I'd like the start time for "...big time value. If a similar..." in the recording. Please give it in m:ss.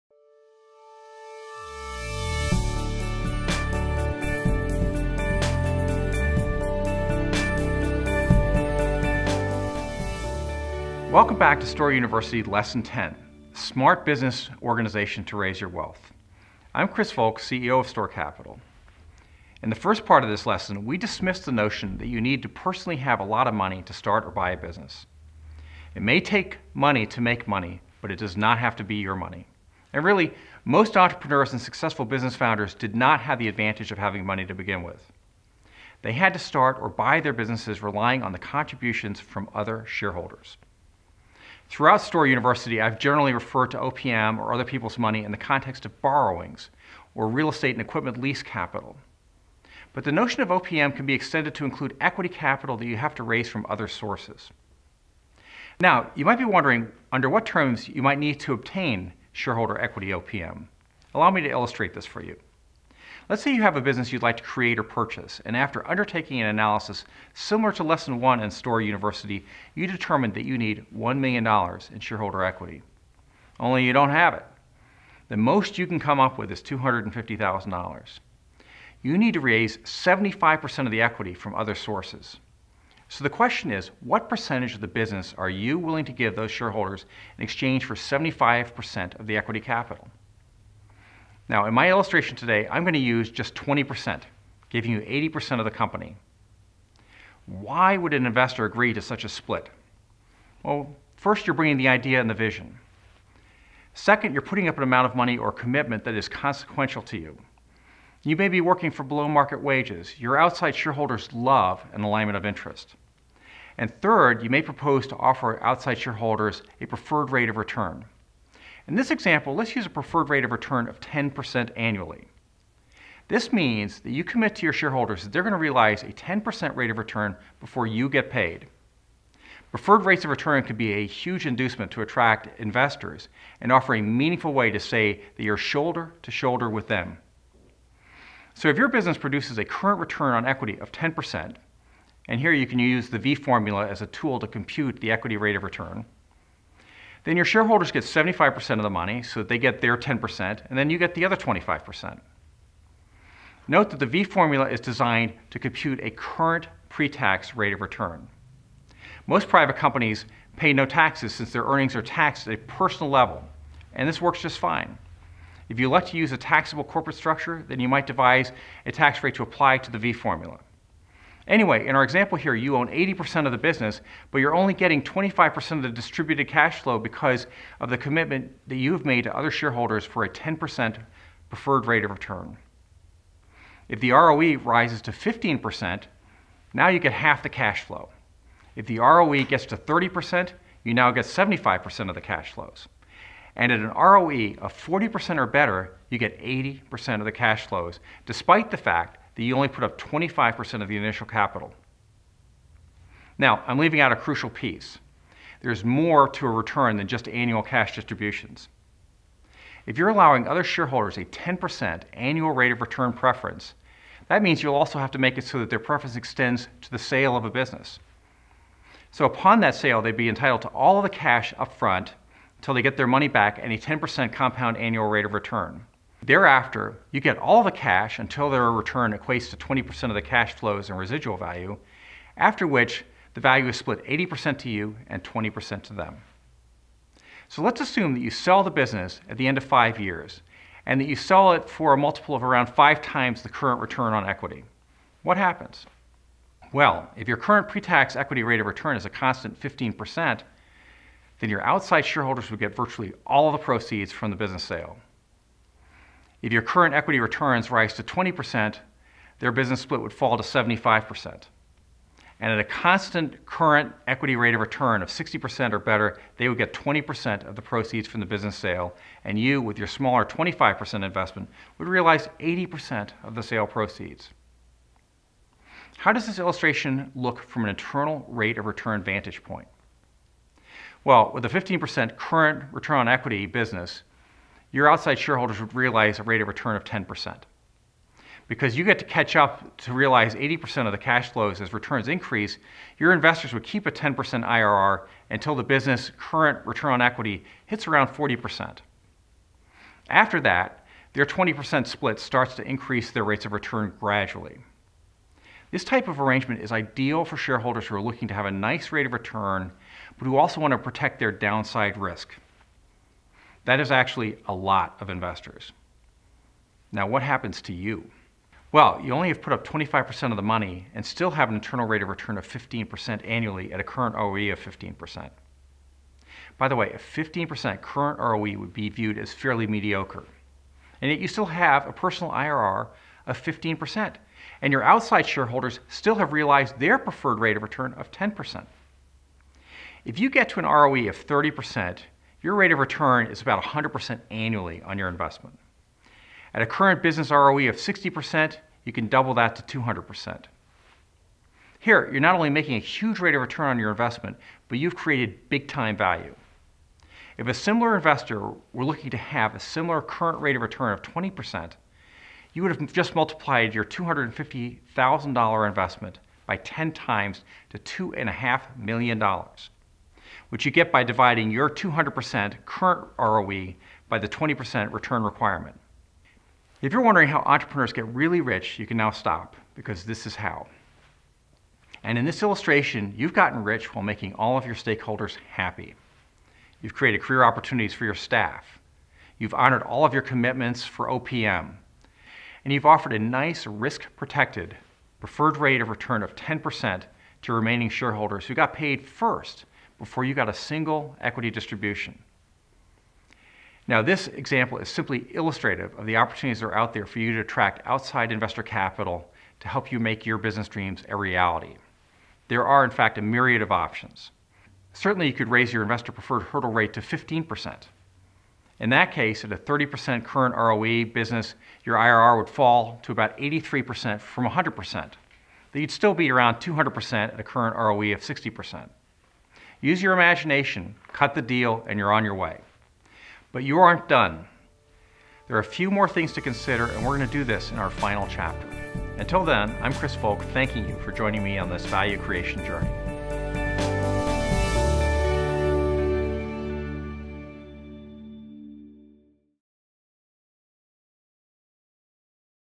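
5:55.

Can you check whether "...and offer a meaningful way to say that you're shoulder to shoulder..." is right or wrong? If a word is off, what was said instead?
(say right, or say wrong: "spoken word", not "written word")
right.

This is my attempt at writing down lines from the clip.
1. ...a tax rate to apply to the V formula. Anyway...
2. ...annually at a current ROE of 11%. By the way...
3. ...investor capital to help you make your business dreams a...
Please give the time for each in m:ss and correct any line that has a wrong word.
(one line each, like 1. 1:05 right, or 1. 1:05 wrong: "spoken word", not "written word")
1. 2:48 right
2. 5:23 wrong: "15", not "11"
3. 6:48 right.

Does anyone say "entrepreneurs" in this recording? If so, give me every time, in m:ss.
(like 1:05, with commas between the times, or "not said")
0:30, 6:17.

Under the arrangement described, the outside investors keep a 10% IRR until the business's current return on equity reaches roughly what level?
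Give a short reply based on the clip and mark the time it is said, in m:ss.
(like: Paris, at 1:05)
40%, at 4:57.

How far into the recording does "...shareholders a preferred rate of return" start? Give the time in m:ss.
1:55.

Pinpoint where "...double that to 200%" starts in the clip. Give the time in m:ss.
5:49.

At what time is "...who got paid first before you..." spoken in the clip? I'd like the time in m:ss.
6:38.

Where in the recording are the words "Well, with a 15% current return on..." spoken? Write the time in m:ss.
4:41.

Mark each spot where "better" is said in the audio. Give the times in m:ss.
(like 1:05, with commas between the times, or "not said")
3:15, 4:25.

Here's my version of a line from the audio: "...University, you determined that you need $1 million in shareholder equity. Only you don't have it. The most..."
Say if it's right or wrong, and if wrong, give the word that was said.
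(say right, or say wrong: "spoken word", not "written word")
right.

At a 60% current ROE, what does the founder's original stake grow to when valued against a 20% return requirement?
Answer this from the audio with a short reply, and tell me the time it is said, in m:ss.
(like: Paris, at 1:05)
$2.5 million, at 6:08.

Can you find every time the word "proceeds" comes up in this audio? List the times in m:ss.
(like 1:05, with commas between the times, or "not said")
4:13, 4:27, 4:33.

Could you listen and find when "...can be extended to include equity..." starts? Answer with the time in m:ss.
0:50.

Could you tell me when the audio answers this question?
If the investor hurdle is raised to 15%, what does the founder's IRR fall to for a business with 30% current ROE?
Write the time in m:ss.
7:03.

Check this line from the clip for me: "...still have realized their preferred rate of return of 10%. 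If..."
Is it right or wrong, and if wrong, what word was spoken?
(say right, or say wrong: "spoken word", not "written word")
right.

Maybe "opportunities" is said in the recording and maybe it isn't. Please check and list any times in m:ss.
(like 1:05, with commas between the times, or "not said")
6:27, 6:46.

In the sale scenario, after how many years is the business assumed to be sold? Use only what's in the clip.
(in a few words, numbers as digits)
5 years.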